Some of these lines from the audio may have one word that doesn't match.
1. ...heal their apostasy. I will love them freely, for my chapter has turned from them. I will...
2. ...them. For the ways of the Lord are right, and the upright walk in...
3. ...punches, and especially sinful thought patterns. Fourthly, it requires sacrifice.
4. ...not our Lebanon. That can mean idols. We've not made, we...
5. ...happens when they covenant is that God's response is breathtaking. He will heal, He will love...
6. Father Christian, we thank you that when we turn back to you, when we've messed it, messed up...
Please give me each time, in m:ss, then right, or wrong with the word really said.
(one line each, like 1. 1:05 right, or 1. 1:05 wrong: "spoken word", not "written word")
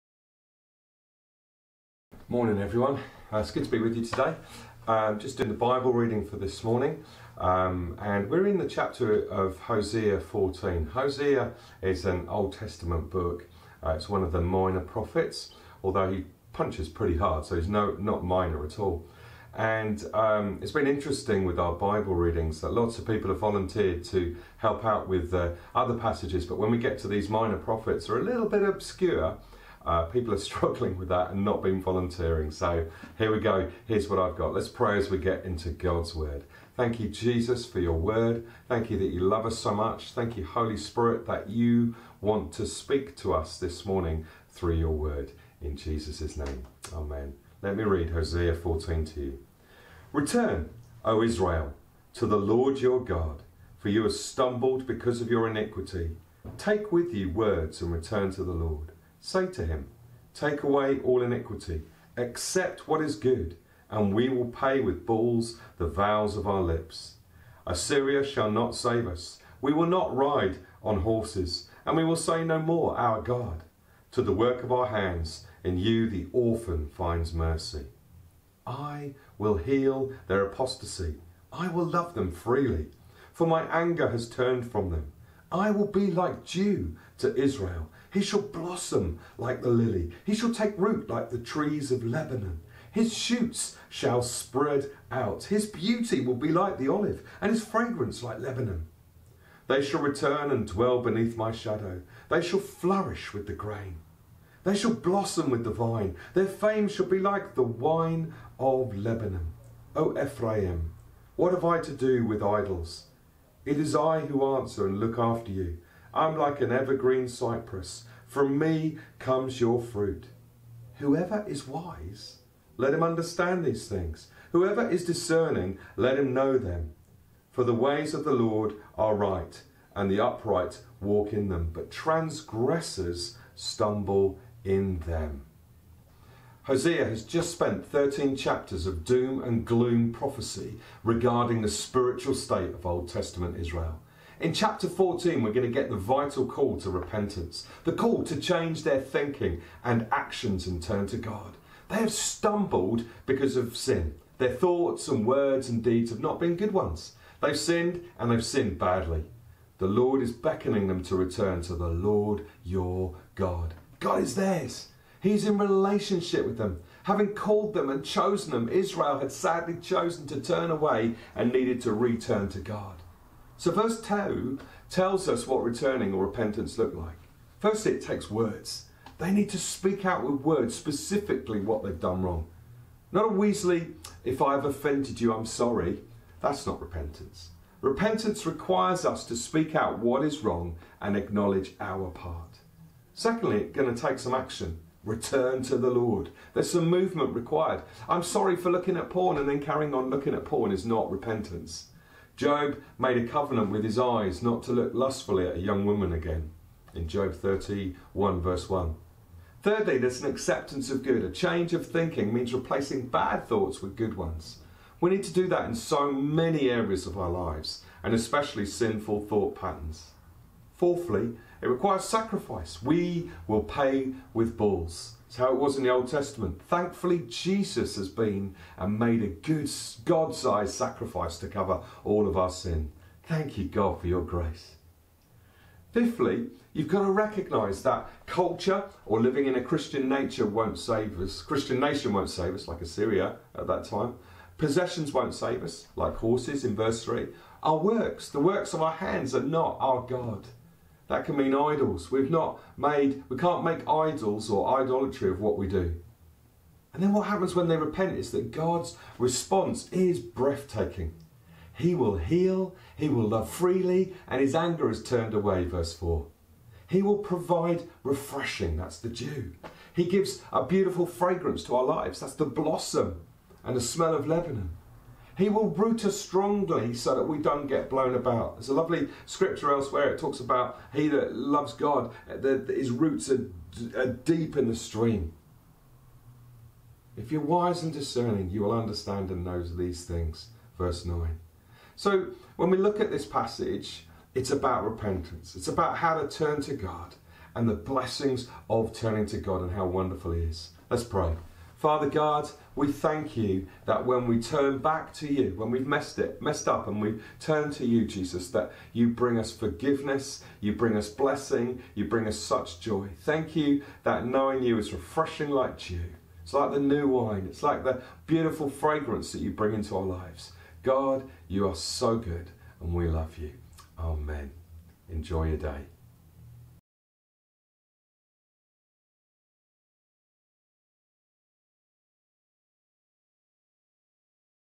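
1. 1:19 wrong: "anger", not "chapter"
2. 2:06 right
3. 3:37 wrong: "lives", not "punches"
4. 4:09 wrong: "God", not "Lebanon"
5. 4:17 wrong: "repent", not "covenant"
6. 5:01 wrong: "God", not "Christian".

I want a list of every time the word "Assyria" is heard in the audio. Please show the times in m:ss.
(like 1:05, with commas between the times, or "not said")
1:07, 4:02.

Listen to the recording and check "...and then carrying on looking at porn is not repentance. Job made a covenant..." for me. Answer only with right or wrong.
right.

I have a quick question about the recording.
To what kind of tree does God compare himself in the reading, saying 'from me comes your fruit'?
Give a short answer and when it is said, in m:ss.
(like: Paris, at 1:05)
evergreen cypress, at 1:56.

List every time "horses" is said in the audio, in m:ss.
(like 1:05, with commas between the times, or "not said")
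1:11, 4:06.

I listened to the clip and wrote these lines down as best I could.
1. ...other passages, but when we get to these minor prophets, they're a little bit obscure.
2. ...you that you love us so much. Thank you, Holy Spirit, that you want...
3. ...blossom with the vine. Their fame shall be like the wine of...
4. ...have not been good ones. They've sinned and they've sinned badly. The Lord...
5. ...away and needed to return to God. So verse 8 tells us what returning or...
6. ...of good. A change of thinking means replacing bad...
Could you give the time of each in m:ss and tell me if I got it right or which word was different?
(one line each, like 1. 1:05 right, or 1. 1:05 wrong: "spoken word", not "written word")
1. 0:25 right
2. 0:38 right
3. 1:44 right
4. 2:36 right
5. 2:50 wrong: "2", not "8"
6. 3:30 right.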